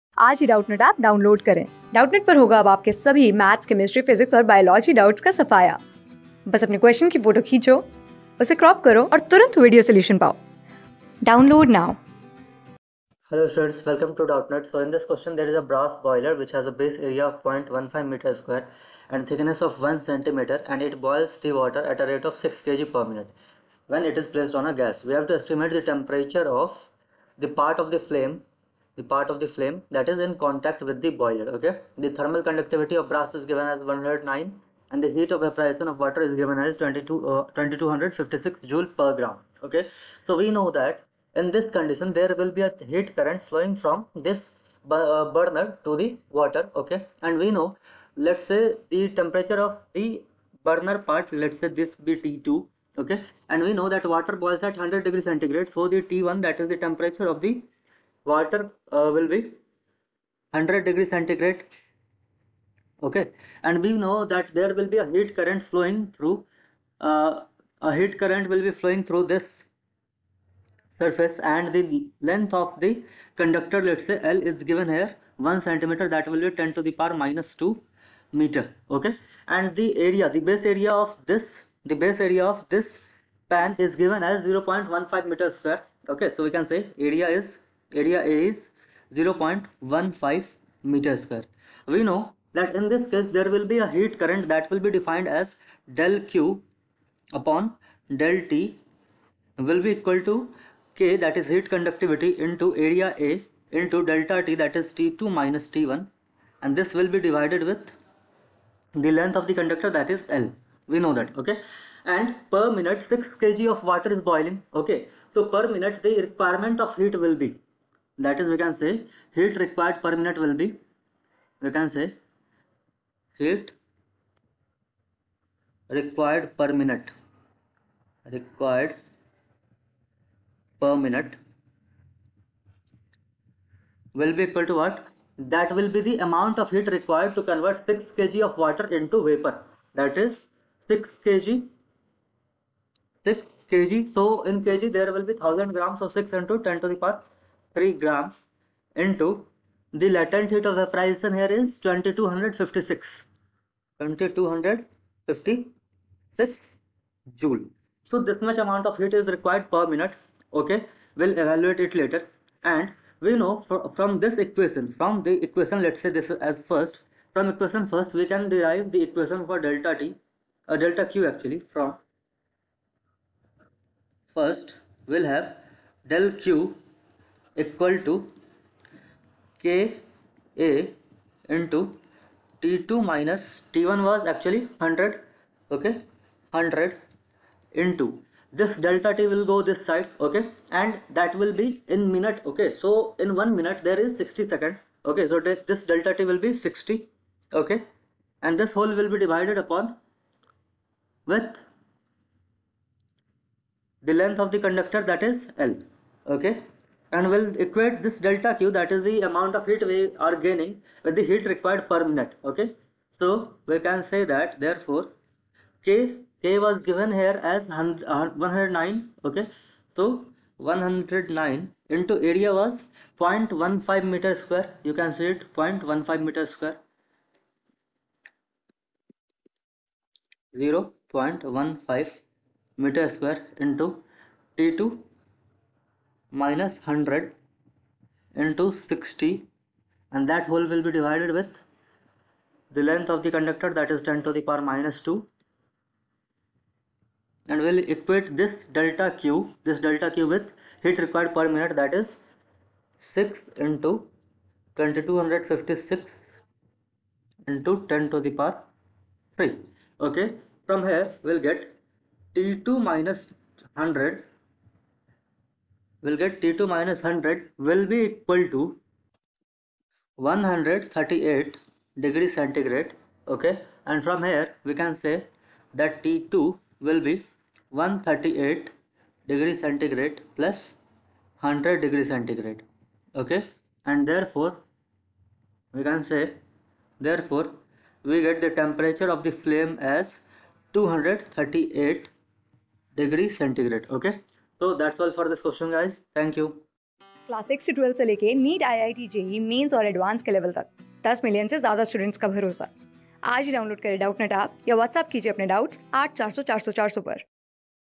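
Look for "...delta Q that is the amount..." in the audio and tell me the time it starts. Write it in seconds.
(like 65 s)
208 s.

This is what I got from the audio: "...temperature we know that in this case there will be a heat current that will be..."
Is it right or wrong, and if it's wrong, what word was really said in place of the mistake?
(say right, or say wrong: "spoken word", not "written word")
wrong: "square", not "temperature".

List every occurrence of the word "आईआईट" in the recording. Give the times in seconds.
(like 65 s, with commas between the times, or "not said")
298 s.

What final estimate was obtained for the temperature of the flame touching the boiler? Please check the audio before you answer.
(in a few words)
238 degrees centigrade.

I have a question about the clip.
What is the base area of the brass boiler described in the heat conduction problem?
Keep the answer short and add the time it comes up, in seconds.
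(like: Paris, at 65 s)
0.15 square meters, at 16 s.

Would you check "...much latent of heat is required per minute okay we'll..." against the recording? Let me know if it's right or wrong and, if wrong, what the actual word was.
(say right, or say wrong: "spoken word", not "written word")
wrong: "amount", not "latent".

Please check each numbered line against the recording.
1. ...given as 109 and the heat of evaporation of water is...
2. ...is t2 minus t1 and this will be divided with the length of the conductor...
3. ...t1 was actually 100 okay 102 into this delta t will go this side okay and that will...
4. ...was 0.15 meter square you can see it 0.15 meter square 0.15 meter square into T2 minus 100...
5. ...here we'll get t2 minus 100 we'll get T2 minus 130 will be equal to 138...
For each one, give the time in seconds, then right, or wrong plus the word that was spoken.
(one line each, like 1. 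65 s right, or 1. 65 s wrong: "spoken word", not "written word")
1. 33 s right
2. 104 s right
3. 183 s wrong: "100", not "102"
4. 222 s right
5. 260 s wrong: "100", not "130".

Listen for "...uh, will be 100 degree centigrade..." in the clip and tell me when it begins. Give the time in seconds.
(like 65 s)
58 s.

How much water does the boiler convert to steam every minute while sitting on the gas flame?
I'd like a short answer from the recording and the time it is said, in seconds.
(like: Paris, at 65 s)
6 kg, at 22 s.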